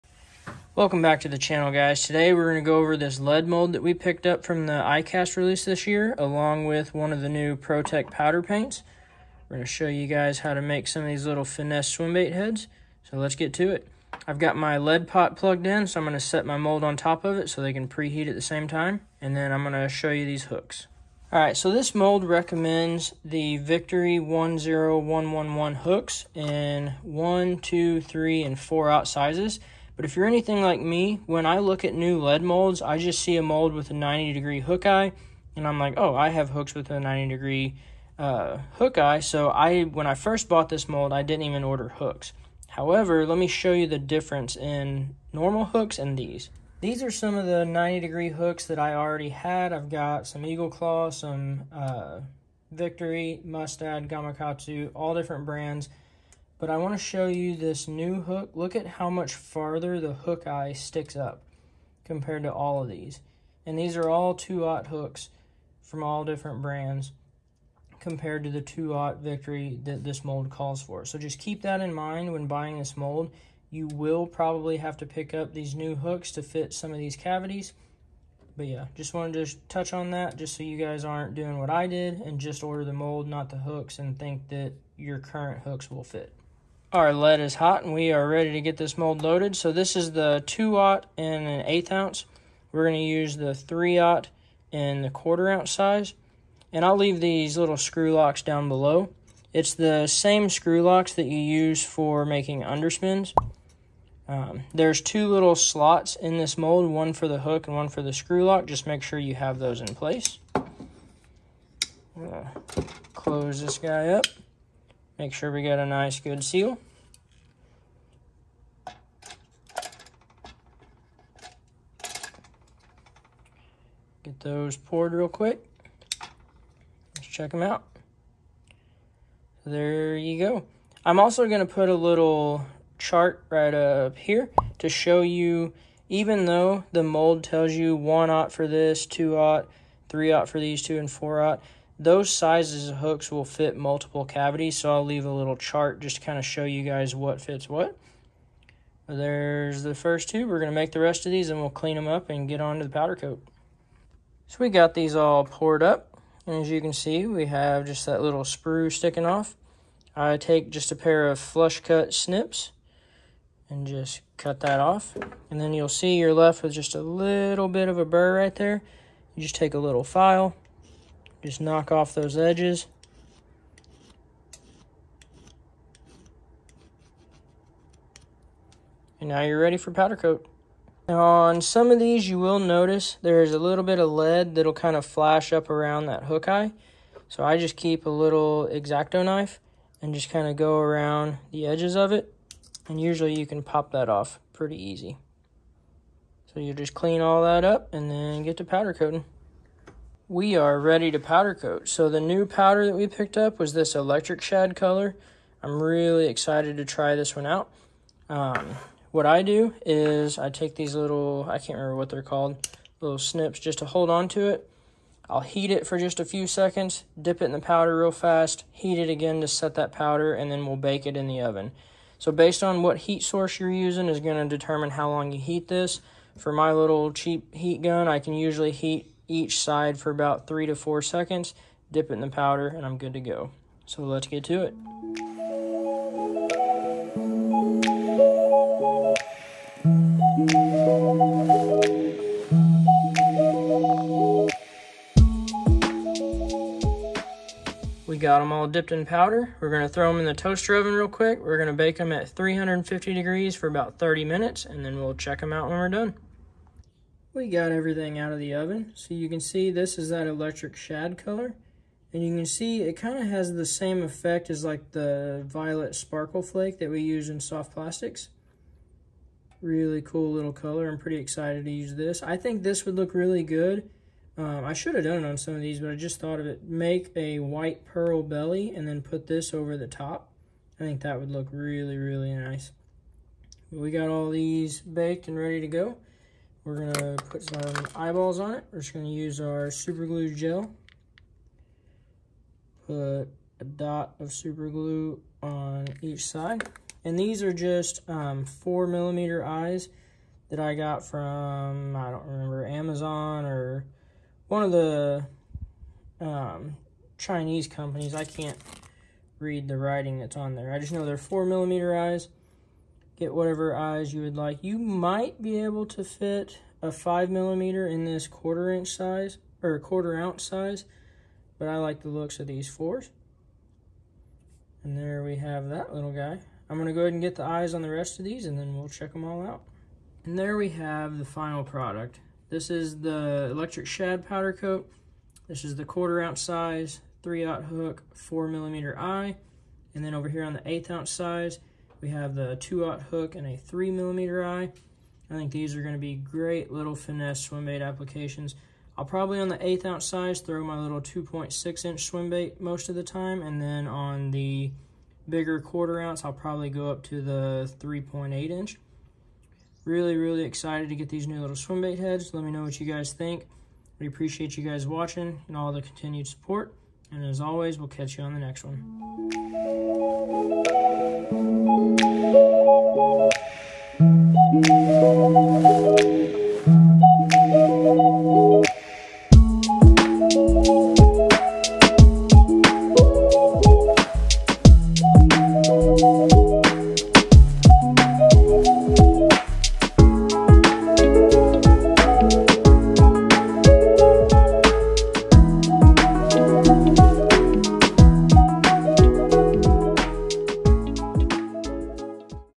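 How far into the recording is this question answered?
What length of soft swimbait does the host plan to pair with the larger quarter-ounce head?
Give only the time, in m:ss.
5:57.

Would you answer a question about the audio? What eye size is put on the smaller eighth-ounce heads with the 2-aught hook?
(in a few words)
3 millimeter.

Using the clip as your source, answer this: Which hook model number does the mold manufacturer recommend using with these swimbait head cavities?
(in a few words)
Victory 10111.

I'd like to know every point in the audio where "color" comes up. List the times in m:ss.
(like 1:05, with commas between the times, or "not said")
3:24, 4:21, 4:30.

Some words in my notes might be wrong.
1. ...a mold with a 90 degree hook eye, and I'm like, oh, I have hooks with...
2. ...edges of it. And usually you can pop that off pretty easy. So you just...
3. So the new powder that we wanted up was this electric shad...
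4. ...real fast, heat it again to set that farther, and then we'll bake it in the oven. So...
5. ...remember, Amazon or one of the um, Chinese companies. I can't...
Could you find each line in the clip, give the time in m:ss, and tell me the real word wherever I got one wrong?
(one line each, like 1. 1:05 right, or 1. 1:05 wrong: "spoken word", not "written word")
1. 0:33 right
2. 3:11 right
3. 3:21 wrong: "picked", not "wanted"
4. 3:37 wrong: "powder", not "farther"
5. 5:02 right.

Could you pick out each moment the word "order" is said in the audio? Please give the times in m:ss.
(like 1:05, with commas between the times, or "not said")
0:41, 1:22.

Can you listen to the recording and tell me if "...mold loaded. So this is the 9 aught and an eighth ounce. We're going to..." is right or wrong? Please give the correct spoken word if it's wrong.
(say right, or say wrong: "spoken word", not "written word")
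wrong: "2", not "9".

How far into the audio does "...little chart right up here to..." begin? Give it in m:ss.
2:11.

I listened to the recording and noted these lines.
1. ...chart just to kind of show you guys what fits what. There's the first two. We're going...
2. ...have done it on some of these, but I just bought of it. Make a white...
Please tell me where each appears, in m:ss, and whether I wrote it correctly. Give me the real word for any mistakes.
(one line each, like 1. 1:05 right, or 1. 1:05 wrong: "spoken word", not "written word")
1. 2:25 right
2. 4:34 wrong: "thought", not "bought".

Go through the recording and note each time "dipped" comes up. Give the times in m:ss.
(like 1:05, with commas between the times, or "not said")
4:08.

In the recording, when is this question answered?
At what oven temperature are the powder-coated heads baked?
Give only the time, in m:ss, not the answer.
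4:12.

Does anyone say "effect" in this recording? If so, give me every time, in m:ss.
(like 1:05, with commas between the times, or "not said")
4:24.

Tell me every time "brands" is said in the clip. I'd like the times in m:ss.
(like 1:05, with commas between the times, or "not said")
0:55, 1:06.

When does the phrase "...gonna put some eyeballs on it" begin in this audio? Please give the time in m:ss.
4:46.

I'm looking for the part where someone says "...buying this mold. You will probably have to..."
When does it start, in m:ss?
1:12.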